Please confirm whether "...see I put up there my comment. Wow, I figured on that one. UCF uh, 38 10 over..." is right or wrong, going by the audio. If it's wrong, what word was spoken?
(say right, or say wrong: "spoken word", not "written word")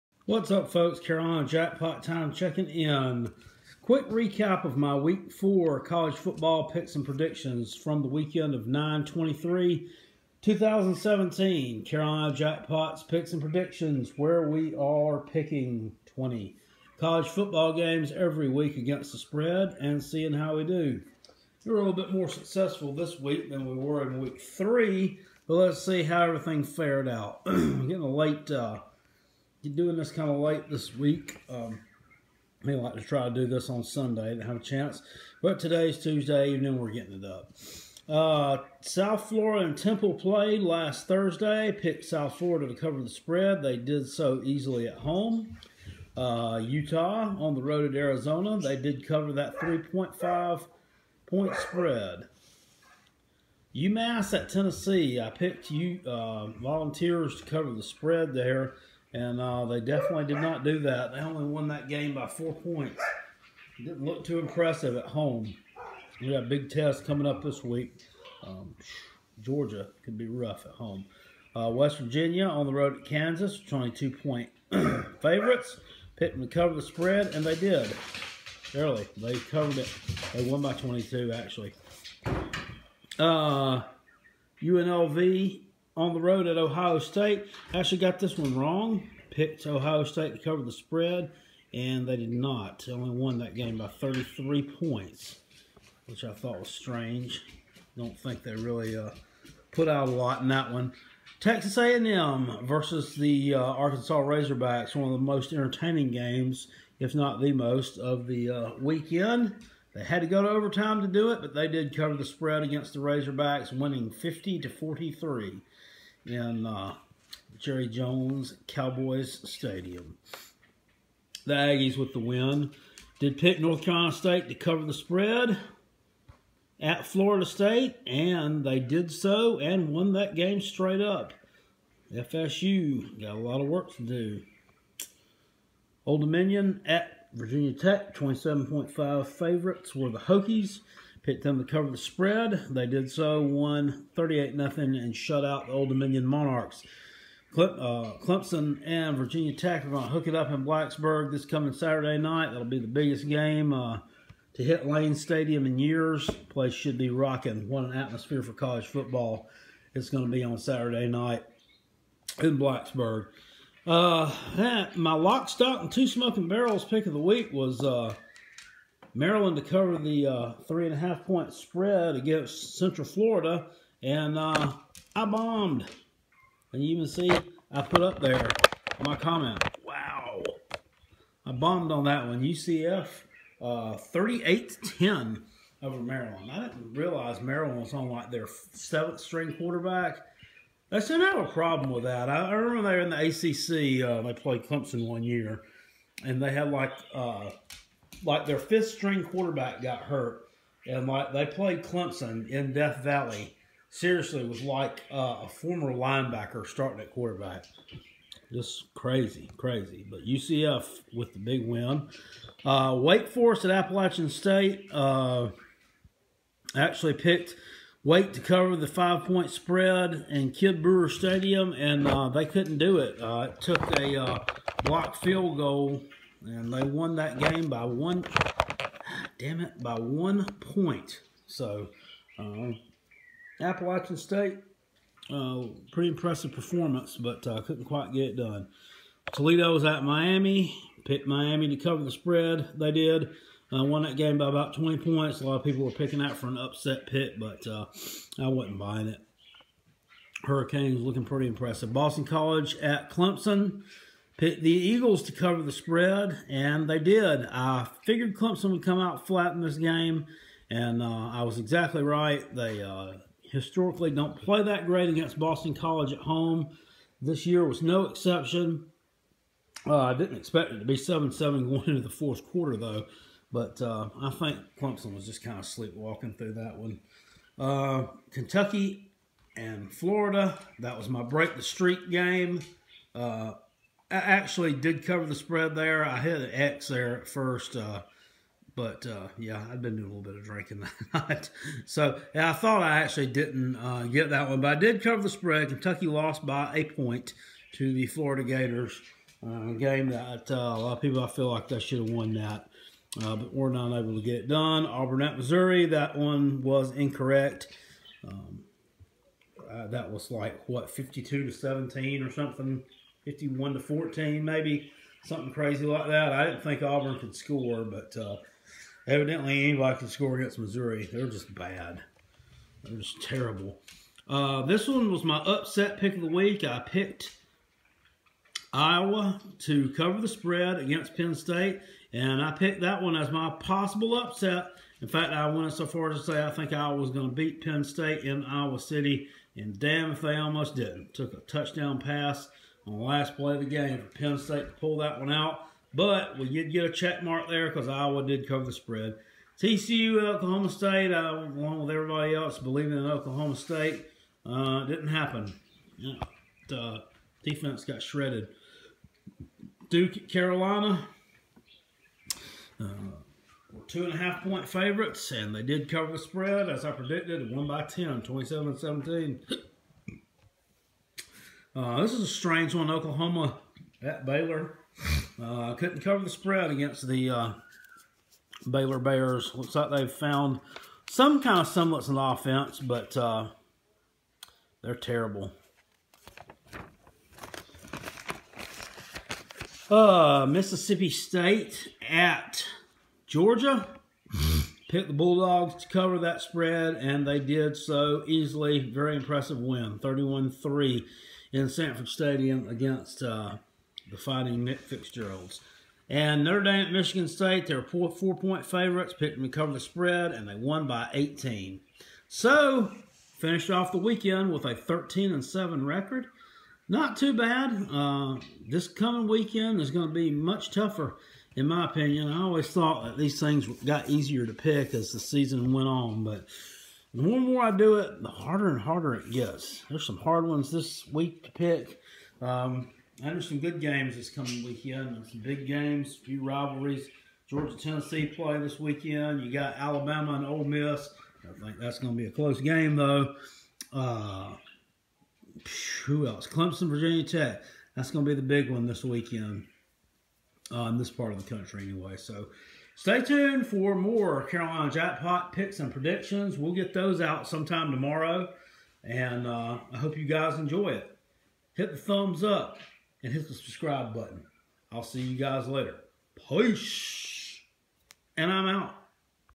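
wrong: "bombed", not "figured".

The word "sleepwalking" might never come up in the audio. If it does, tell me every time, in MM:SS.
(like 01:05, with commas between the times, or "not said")
04:35.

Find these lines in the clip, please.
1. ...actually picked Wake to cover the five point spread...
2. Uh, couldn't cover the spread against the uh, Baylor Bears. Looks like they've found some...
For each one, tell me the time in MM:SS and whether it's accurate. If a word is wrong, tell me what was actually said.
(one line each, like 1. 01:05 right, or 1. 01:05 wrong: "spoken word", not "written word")
1. 03:36 right
2. 06:15 right.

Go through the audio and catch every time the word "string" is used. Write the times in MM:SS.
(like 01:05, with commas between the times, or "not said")
03:09, 03:18.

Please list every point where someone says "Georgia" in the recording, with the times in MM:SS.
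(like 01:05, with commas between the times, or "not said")
01:09, 06:33, 07:17.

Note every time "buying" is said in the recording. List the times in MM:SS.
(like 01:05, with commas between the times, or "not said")
04:08.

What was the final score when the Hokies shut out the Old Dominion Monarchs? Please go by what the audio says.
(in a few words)
38-0.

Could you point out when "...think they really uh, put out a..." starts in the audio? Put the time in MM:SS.
01:38.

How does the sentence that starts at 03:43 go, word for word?
Uh, it took a uh, blocked field goal and they won that game by one.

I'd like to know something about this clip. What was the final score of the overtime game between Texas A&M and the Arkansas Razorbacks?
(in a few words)
50 to 43.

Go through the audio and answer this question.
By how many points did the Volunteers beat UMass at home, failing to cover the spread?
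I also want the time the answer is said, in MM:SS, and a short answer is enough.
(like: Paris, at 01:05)
4, at 01:02.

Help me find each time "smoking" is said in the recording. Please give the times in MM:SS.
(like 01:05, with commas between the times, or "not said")
02:46.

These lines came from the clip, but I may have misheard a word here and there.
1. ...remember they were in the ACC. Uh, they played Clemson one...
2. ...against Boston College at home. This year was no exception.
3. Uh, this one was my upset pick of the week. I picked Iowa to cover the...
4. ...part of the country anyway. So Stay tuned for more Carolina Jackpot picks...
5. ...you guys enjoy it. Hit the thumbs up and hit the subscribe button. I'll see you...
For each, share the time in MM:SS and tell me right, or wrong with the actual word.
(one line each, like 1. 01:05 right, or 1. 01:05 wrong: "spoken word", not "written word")
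1. 03:12 right
2. 04:25 right
3. 05:24 right
4. 07:31 right
5. 07:40 right.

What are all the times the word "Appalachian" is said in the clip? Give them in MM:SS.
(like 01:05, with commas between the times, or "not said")
03:33, 03:53.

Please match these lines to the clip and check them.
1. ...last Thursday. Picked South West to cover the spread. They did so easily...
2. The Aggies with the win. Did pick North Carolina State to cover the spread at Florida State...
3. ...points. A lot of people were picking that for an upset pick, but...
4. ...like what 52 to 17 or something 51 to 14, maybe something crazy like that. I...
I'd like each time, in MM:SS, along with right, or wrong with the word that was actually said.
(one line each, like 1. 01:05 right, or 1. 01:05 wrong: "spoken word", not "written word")
1. 00:40 wrong: "Florida", not "West"
2. 02:01 right
3. 04:04 right
4. 05:10 right.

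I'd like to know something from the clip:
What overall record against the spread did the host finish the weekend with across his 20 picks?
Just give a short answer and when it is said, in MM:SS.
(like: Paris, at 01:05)
13 and 7, at 06:54.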